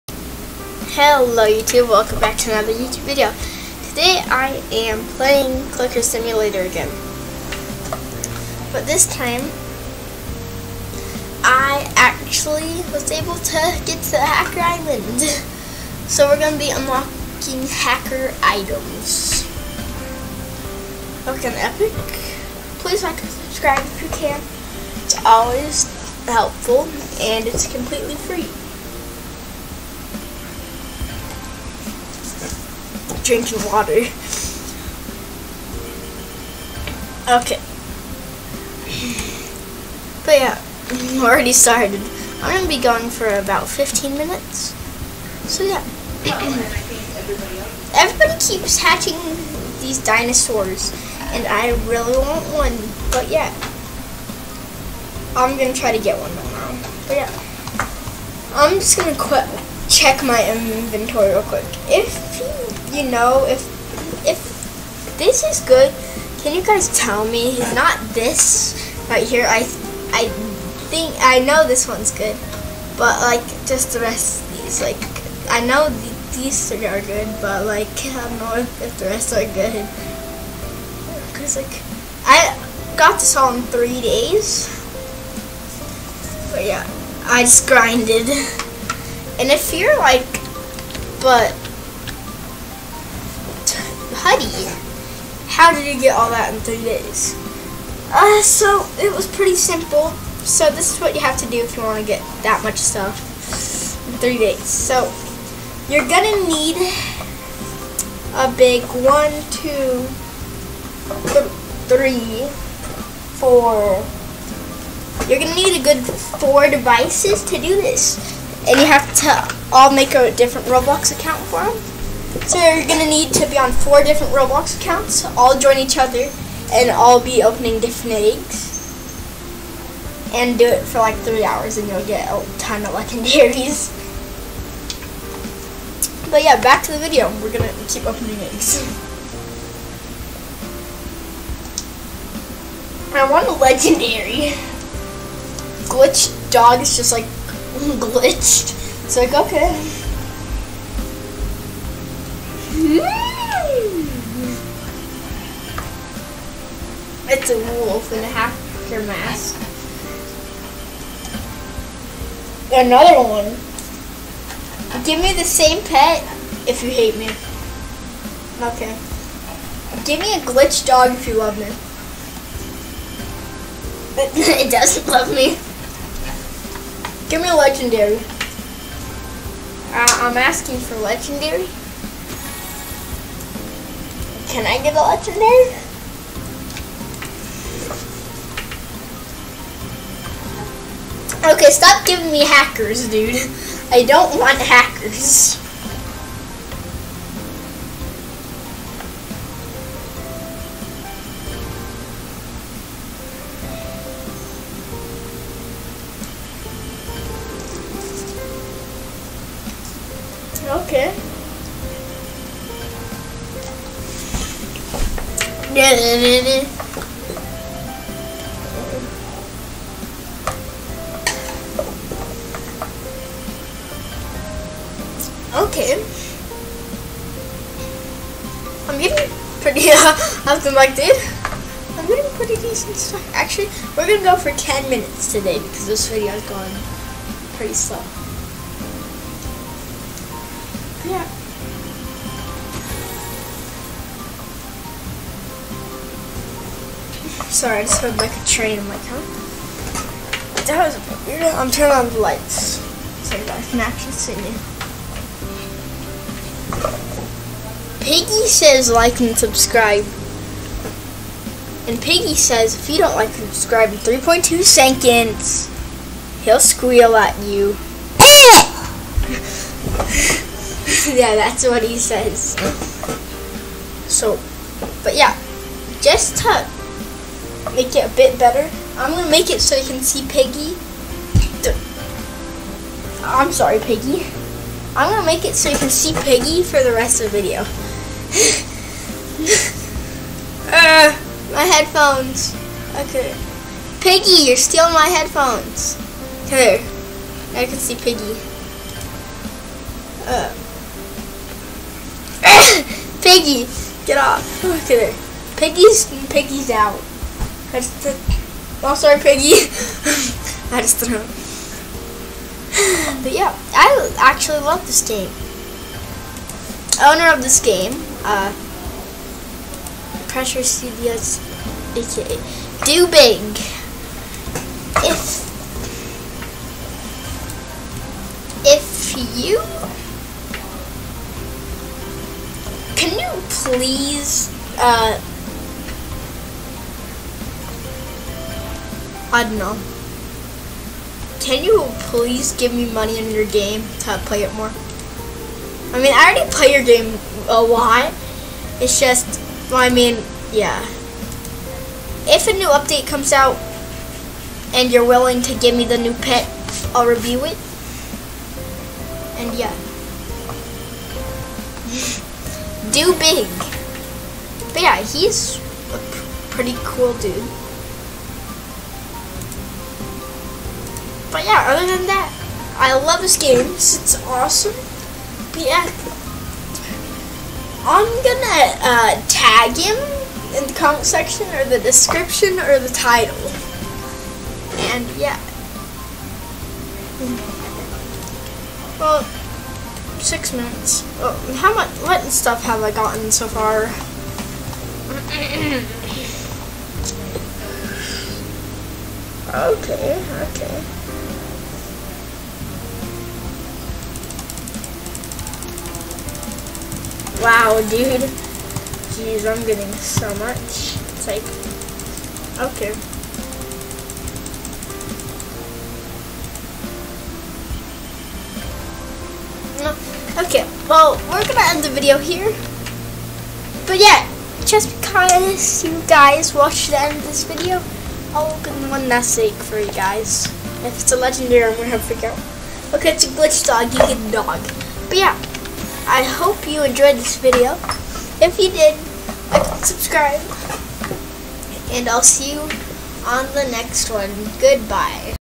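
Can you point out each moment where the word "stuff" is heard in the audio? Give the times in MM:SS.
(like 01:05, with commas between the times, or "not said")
01:42, 03:52, 06:32.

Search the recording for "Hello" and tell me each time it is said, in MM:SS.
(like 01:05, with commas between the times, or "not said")
00:00.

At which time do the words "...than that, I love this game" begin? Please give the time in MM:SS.
06:11.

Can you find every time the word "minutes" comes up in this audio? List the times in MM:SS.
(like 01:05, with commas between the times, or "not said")
00:44, 03:54, 06:30.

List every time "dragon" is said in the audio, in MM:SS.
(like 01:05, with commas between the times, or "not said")
not said.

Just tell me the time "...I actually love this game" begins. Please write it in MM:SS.
05:13.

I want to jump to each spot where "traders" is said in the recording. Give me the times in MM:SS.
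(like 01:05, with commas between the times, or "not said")
not said.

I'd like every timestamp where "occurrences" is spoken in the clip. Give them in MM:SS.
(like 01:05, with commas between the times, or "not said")
not said.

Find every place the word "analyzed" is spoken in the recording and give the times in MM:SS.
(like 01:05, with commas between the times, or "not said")
not said.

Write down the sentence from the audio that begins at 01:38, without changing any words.
Uh, so it was pretty simple.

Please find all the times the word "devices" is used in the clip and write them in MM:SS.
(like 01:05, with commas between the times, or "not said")
01:56.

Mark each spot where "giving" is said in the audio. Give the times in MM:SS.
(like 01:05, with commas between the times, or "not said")
03:12.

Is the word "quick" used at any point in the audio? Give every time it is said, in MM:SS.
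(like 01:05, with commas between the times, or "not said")
01:01.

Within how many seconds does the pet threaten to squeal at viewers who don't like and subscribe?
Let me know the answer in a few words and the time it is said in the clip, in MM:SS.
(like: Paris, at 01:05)
3.2, at 04:23.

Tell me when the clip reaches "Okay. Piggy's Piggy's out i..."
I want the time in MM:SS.
05:04.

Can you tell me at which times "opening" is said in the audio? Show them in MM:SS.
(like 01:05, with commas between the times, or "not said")
02:07, 02:18.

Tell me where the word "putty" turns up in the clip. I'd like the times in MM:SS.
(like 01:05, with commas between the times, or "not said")
01:34.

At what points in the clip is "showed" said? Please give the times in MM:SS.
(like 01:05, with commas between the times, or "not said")
not said.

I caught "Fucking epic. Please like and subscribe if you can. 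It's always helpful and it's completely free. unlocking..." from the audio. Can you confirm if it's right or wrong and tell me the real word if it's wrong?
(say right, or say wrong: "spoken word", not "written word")
wrong: "drinking", not "unlocking".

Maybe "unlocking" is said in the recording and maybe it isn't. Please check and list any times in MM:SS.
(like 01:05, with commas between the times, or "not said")
00:16.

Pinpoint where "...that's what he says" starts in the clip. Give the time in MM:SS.
04:31.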